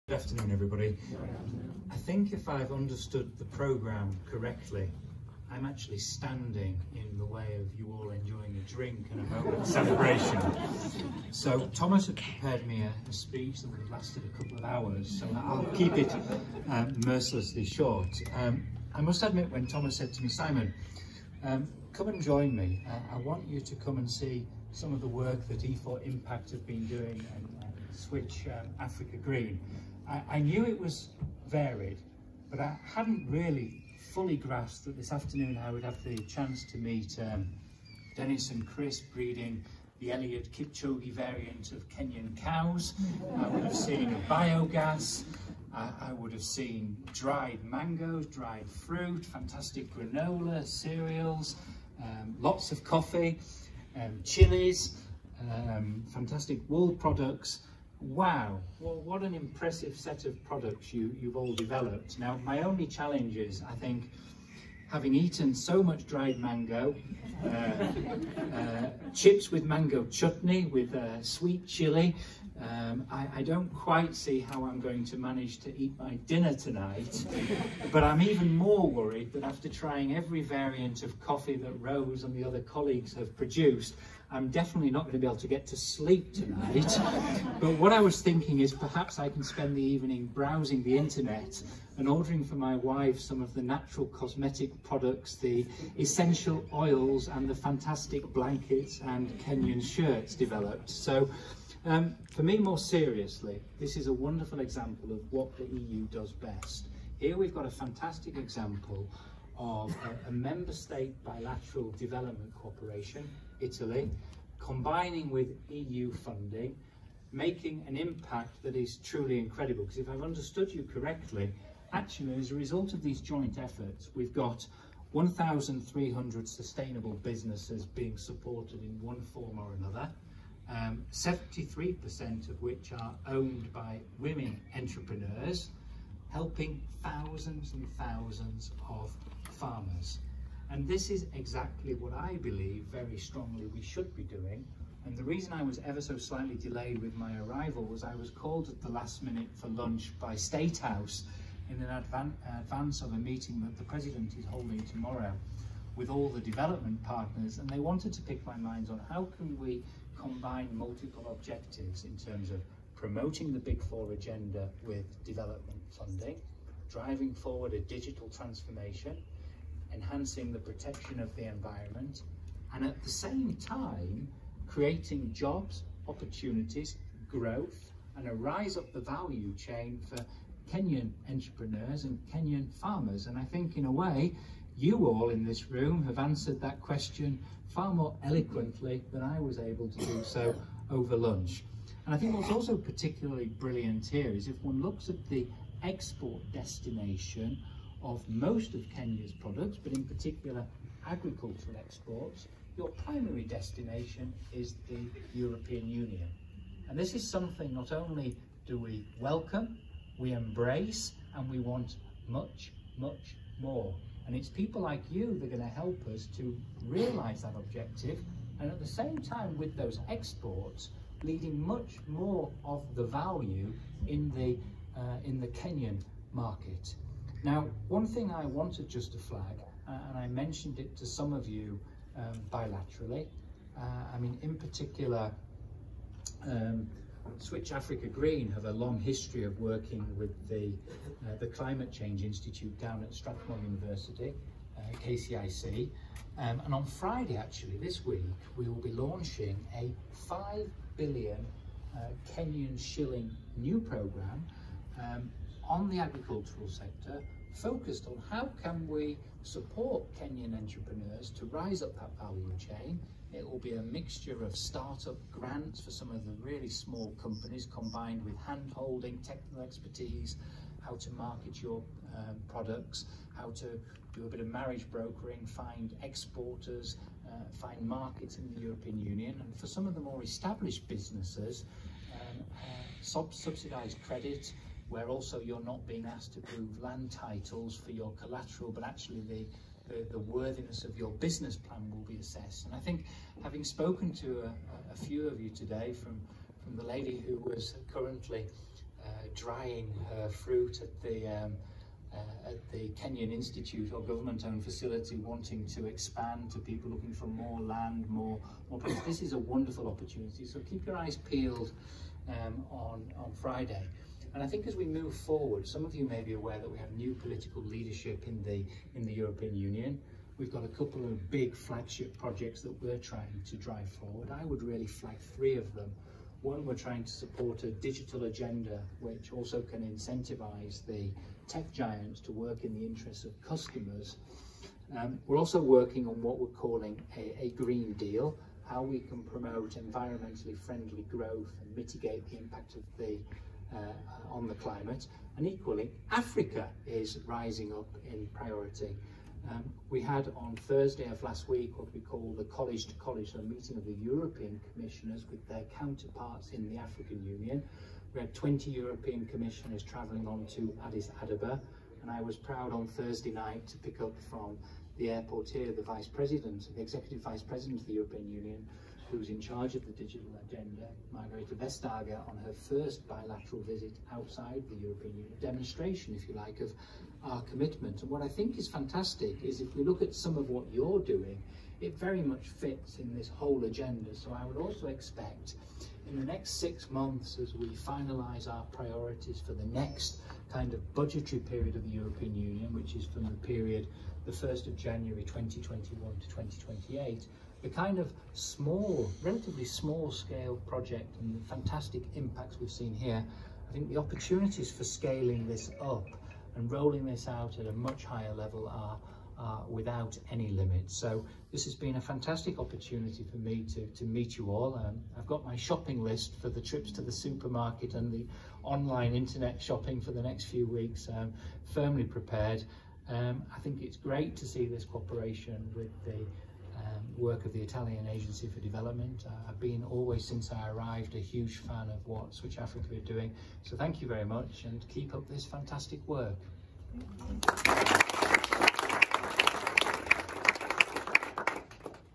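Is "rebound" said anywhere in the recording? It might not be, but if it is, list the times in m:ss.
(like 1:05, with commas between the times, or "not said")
not said.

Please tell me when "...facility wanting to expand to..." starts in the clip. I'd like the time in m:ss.
5:04.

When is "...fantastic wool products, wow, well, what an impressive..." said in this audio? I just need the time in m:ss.
0:56.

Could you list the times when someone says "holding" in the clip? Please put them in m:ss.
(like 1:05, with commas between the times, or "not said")
2:34, 4:28.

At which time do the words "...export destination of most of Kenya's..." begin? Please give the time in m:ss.
3:15.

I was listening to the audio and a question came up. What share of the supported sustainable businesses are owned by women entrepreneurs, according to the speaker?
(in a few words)
73%.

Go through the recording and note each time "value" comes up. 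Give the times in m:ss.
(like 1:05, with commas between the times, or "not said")
2:58, 3:43, 4:22.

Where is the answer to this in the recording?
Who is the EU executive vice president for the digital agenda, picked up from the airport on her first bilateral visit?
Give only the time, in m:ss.
6:11.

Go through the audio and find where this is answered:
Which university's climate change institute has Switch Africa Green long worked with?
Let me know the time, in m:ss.
4:03.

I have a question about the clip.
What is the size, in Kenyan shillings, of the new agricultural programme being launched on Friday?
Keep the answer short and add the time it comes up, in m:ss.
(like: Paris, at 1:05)
5 billion, at 4:10.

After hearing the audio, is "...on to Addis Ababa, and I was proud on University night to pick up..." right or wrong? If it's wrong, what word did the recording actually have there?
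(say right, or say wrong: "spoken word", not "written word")
wrong: "Thursday", not "University".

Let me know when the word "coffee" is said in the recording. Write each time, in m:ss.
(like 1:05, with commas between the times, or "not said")
0:52, 1:21.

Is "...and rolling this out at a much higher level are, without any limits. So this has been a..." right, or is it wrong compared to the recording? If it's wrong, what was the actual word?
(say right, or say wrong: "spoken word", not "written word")
right.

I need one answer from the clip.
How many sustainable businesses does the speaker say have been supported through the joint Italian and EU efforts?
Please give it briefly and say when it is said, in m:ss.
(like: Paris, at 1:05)
1,300, at 2:05.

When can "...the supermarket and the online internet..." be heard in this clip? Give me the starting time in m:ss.
6:57.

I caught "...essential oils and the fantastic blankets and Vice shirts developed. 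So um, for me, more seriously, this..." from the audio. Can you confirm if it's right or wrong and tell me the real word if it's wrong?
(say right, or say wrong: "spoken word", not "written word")
wrong: "Kenyan", not "Vice".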